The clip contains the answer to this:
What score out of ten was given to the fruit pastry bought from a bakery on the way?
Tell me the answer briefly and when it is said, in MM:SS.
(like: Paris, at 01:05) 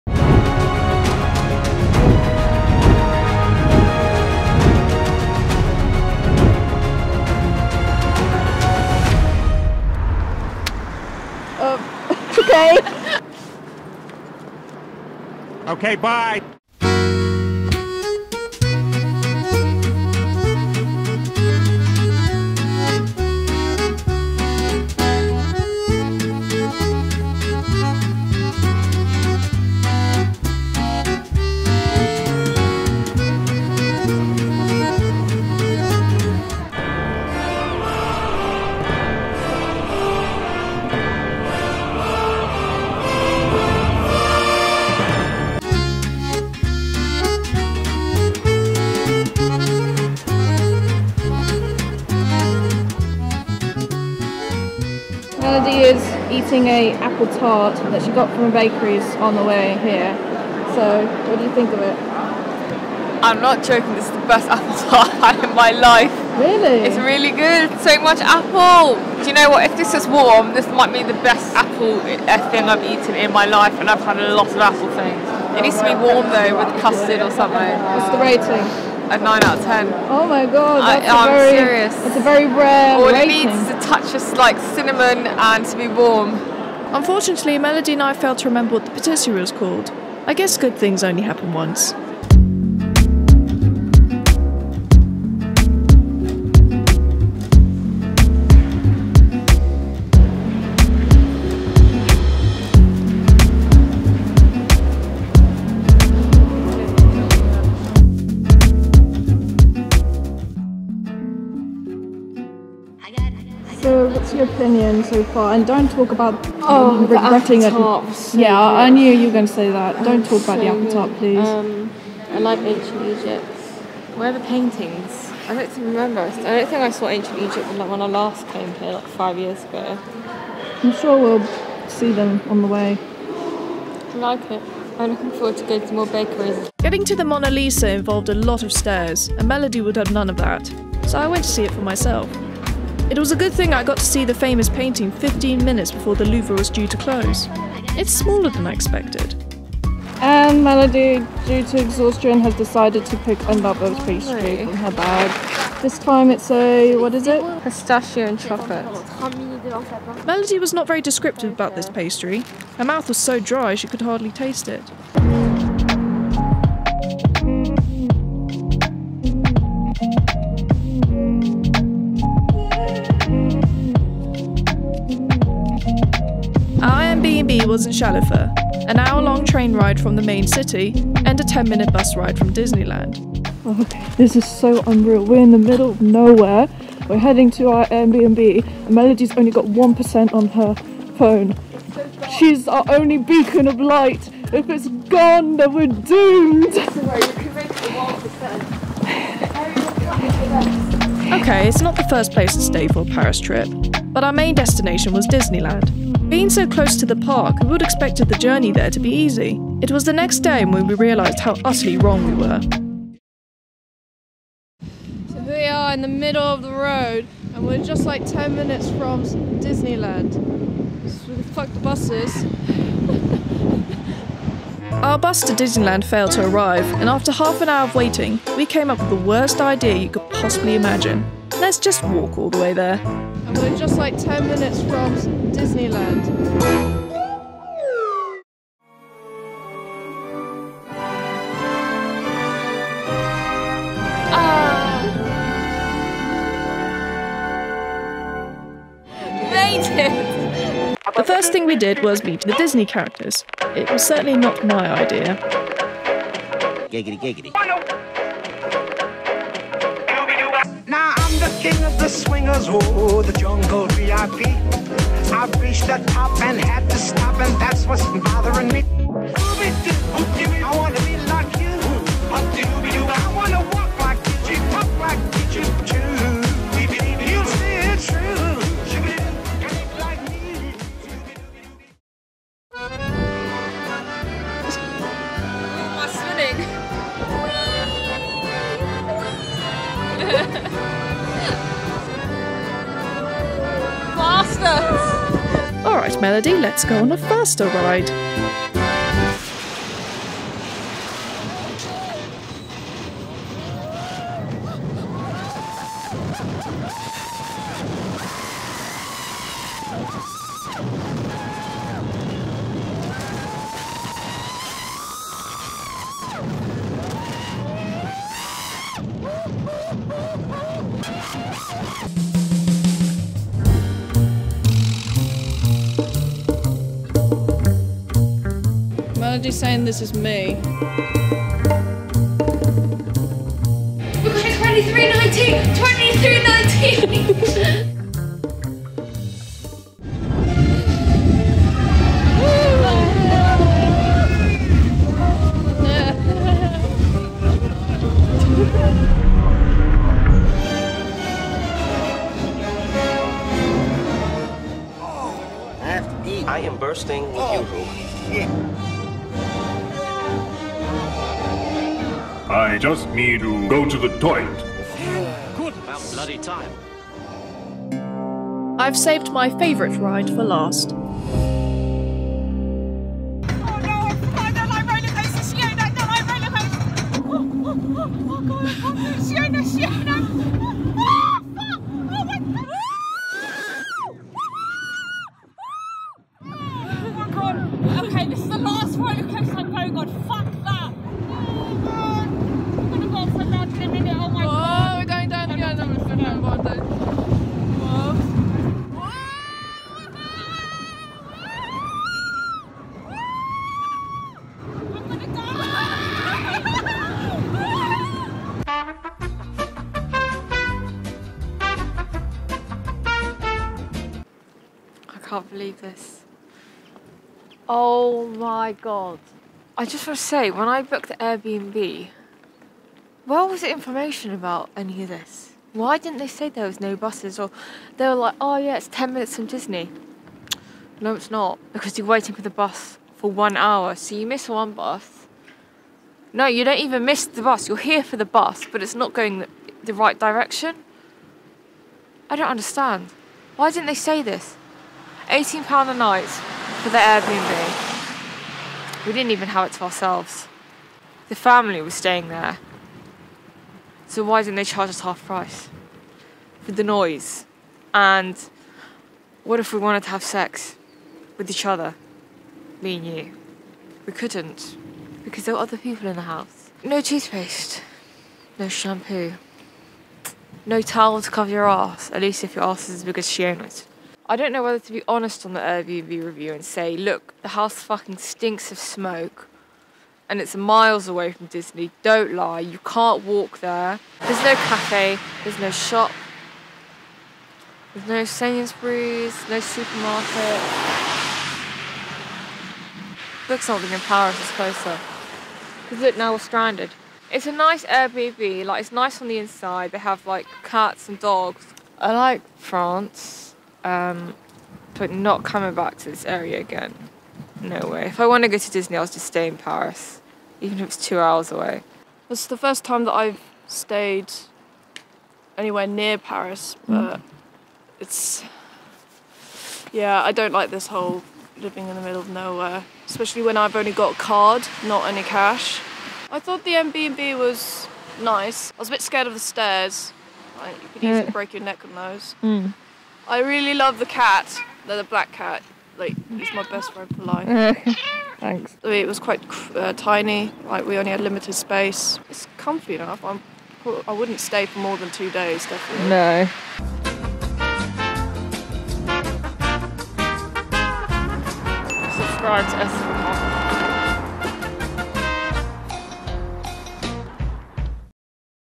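9, at 01:19.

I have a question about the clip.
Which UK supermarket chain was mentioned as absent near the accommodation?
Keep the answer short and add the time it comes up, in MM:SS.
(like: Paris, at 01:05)
Sainsbury's, at 08:08.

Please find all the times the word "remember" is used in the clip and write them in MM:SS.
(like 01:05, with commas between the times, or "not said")
01:28, 02:05.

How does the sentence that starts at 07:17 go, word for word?
You're here for the bus, but it's not going the, the right direction.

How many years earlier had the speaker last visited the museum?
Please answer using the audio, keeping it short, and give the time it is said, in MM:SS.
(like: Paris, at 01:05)
5 years, at 02:09.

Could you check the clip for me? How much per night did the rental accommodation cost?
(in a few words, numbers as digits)
£18.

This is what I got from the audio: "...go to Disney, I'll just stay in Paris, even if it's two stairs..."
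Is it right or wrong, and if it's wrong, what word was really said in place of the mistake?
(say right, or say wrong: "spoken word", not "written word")
wrong: "hours", not "stairs".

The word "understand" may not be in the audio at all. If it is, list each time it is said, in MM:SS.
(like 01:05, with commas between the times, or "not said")
07:22.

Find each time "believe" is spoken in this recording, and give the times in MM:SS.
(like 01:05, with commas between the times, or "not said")
06:55.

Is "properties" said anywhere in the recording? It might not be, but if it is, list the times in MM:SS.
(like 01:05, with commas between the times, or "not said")
not said.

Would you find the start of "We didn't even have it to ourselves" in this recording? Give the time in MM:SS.
07:29.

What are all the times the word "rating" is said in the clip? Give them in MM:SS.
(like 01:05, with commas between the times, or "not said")
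01:18, 01:23.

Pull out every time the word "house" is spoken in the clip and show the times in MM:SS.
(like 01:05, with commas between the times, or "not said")
07:46, 07:57.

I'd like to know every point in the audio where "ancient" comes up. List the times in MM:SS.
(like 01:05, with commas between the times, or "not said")
02:02, 02:07.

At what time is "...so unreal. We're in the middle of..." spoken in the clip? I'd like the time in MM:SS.
03:04.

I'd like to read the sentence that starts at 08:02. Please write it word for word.
Don't lie, you can't walk there.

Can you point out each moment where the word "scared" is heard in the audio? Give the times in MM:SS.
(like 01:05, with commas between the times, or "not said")
08:49.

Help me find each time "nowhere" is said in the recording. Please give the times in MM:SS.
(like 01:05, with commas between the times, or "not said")
03:06, 08:42.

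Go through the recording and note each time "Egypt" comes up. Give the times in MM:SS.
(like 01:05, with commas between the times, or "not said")
02:03, 02:07.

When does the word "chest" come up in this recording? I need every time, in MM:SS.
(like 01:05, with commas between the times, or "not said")
not said.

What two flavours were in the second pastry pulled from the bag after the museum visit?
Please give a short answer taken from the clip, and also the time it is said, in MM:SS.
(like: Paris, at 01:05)
Pistachio and chocolate, at 02:37.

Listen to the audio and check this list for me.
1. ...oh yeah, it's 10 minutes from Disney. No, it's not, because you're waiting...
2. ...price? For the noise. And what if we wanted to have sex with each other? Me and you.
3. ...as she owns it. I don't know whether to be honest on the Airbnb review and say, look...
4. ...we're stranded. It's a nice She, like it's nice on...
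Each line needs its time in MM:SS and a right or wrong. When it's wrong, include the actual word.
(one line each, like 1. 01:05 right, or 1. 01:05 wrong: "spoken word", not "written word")
1. 07:08 right
2. 07:35 right
3. 07:53 right
4. 08:16 wrong: "Airbnb", not "She".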